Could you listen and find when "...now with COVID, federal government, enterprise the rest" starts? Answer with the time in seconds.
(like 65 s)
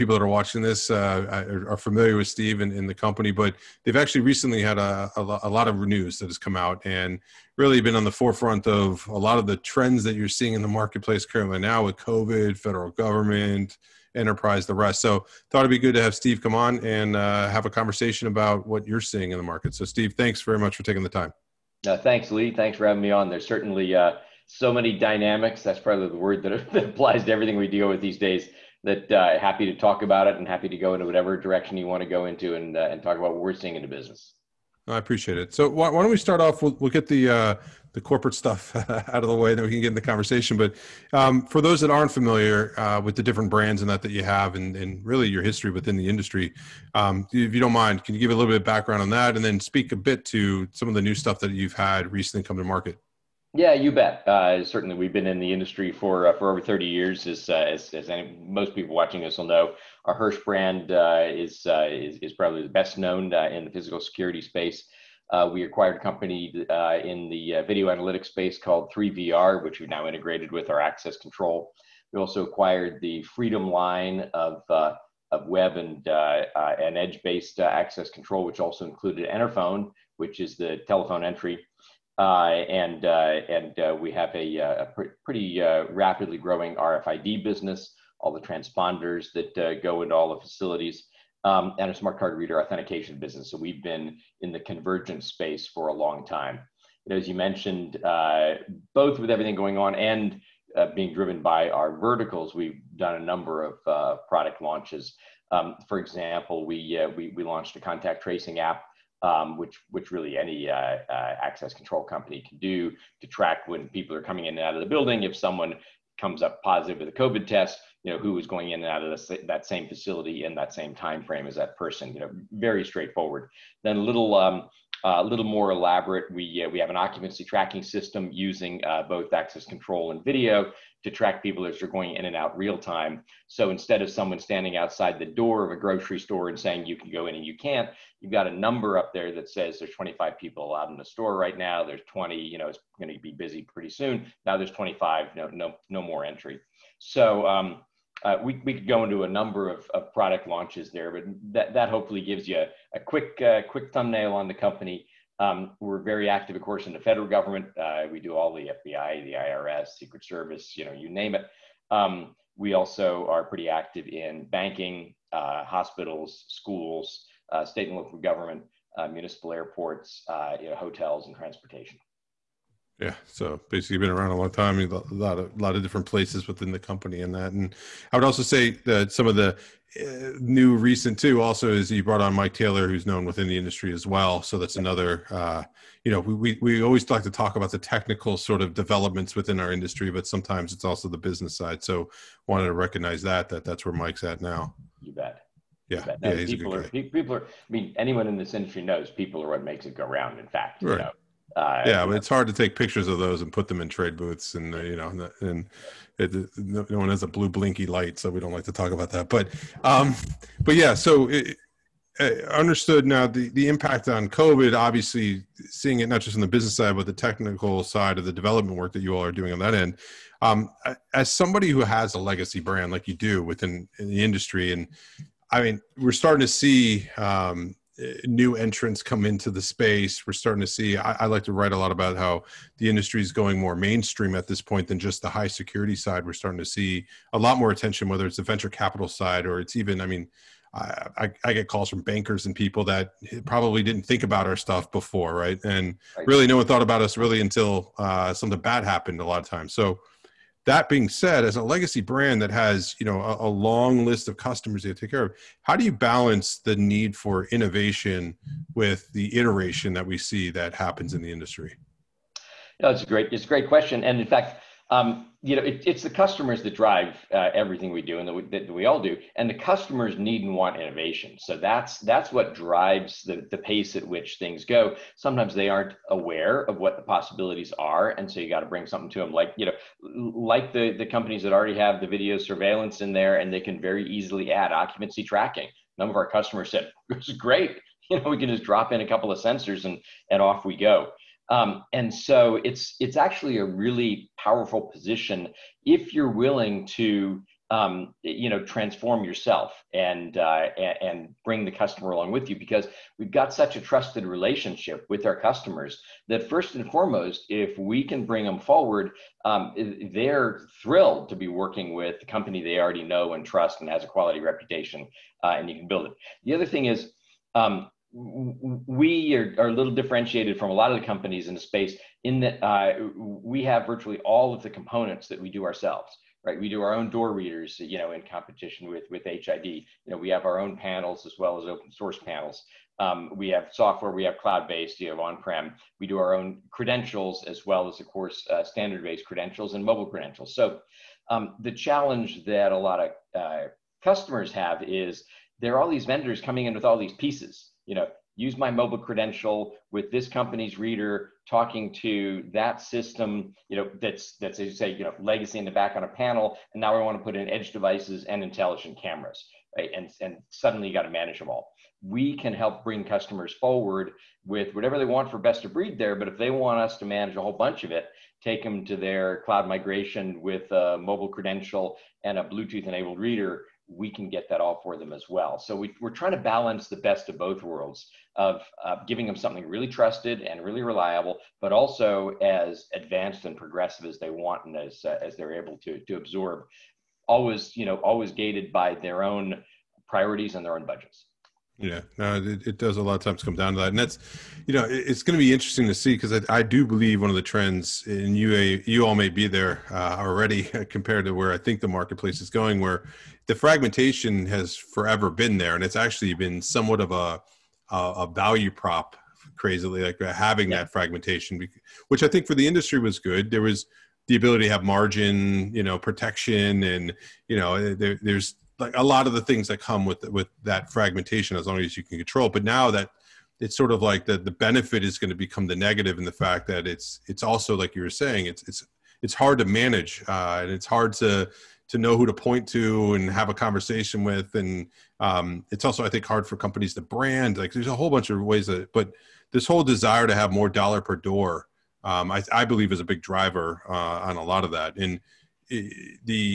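11 s.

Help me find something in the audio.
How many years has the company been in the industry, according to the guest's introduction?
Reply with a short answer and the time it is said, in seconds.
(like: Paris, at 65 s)
Over 30 years, at 56 s.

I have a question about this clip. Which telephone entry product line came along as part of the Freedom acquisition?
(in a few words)
Enterphone.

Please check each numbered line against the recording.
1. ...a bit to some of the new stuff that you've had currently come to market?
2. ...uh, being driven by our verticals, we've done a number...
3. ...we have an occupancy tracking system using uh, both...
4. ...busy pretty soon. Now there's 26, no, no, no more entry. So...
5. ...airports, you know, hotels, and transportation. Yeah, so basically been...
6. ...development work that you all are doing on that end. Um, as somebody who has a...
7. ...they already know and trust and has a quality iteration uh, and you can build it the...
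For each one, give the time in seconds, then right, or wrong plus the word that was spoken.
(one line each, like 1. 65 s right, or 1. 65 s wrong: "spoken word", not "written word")
1. 49 s wrong: "recently", not "currently"
2. 100 s right
3. 126 s right
4. 143 s wrong: "25", not "26"
5. 169 s right
6. 218 s right
7. 312 s wrong: "reputation", not "iteration".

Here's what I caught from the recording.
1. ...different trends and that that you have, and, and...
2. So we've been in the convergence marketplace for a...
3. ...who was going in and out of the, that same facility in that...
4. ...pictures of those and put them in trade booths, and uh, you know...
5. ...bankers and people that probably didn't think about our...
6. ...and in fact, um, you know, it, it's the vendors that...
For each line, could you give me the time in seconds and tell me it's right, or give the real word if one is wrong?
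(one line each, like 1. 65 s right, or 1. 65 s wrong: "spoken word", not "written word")
1. 43 s wrong: "brands", not "trends"
2. 93 s wrong: "space", not "marketplace"
3. 118 s right
4. 202 s right
5. 242 s right
6. 264 s wrong: "customers", not "vendors".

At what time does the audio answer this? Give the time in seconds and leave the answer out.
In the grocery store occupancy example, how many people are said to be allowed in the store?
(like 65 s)
139 s.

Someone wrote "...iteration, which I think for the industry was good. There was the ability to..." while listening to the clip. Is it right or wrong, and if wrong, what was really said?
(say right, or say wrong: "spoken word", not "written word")
wrong: "fragmentation", not "iteration".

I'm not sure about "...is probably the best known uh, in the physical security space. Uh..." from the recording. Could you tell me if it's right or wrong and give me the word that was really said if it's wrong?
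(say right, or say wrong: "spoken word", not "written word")
right.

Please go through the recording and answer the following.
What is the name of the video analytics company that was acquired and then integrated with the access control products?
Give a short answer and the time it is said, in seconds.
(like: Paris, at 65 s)
3VR, at 68 s.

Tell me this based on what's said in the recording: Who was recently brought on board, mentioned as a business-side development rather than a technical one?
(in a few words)
Mike Taylor.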